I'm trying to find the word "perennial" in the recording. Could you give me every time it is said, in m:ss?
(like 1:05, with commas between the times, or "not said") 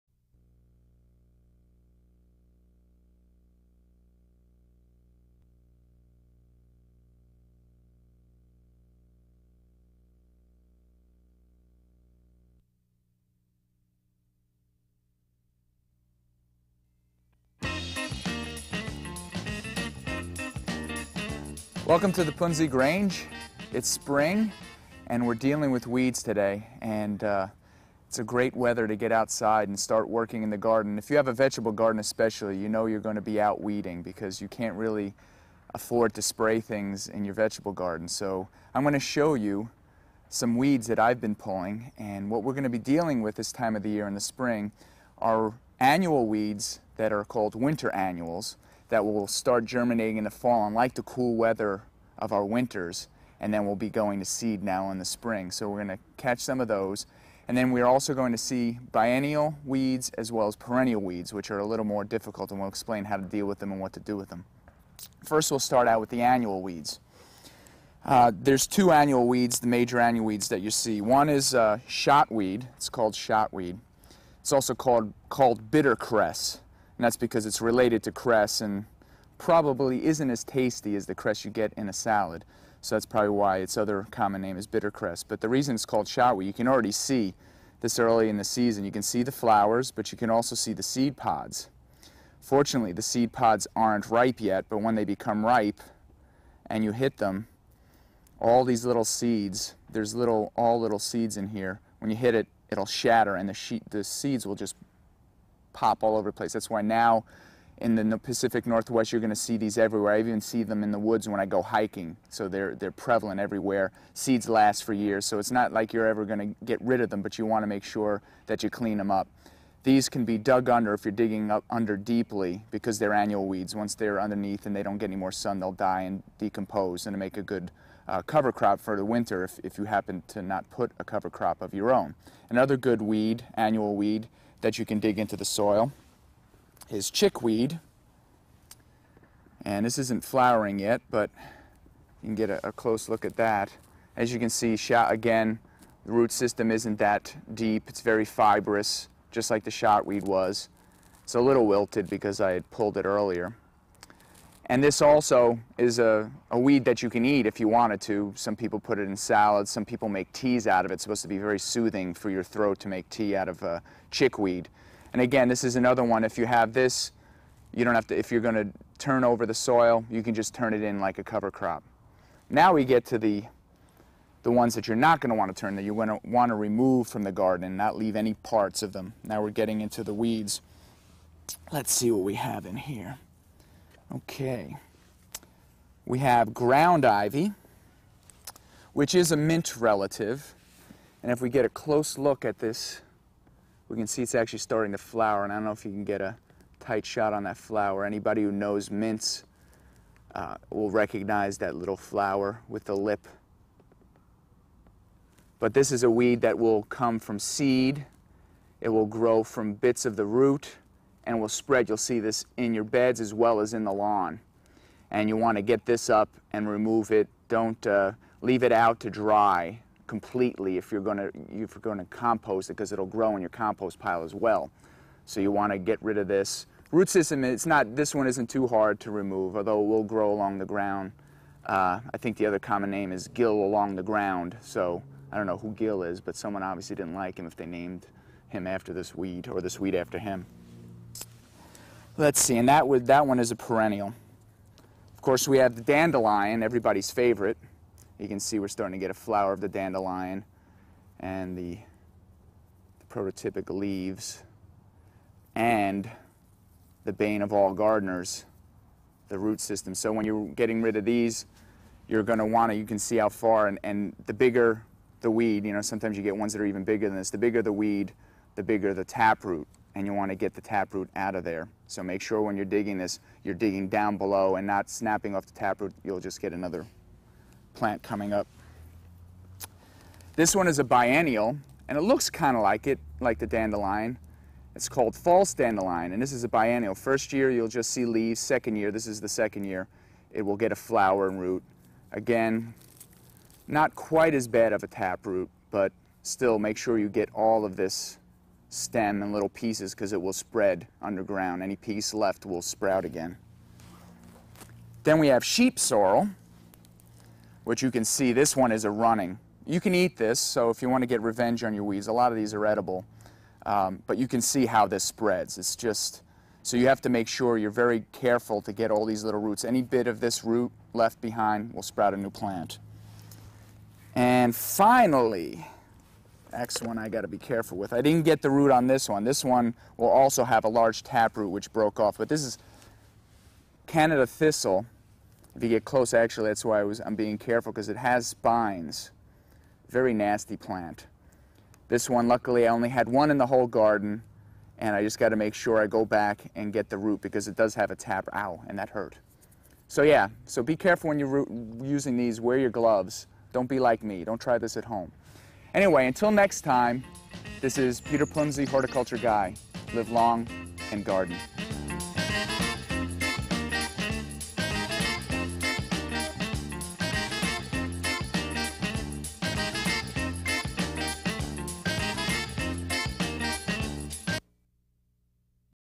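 1:00, 4:03.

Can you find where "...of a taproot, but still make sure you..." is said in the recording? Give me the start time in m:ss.
4:54.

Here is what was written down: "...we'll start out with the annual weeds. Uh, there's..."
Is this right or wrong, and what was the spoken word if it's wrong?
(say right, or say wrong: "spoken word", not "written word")
right.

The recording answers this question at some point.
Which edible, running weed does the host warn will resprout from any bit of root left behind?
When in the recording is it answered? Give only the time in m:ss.
5:05.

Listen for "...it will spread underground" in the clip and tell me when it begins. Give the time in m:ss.
5:00.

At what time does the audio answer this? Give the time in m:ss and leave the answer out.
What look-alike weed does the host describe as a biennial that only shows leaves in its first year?
4:45.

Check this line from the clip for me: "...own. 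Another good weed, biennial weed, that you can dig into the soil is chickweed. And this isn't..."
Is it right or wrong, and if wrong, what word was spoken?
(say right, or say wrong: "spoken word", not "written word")
wrong: "annual", not "biennial".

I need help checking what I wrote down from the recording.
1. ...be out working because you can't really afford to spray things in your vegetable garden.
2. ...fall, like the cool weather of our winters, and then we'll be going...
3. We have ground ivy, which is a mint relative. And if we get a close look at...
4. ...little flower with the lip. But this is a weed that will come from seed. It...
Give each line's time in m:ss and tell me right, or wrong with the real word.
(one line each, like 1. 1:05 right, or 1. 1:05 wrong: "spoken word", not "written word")
1. 0:33 wrong: "weeding", not "working"
2. 0:50 right
3. 3:06 right
4. 3:21 right.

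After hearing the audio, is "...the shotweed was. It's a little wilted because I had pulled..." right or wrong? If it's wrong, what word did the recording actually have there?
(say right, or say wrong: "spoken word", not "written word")
right.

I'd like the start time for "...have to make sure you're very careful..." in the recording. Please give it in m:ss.
5:16.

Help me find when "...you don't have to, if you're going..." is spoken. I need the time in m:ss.
2:47.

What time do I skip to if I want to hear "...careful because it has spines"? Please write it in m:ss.
5:37.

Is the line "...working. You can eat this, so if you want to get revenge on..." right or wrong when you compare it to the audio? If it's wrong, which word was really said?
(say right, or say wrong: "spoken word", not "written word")
wrong: "running", not "working".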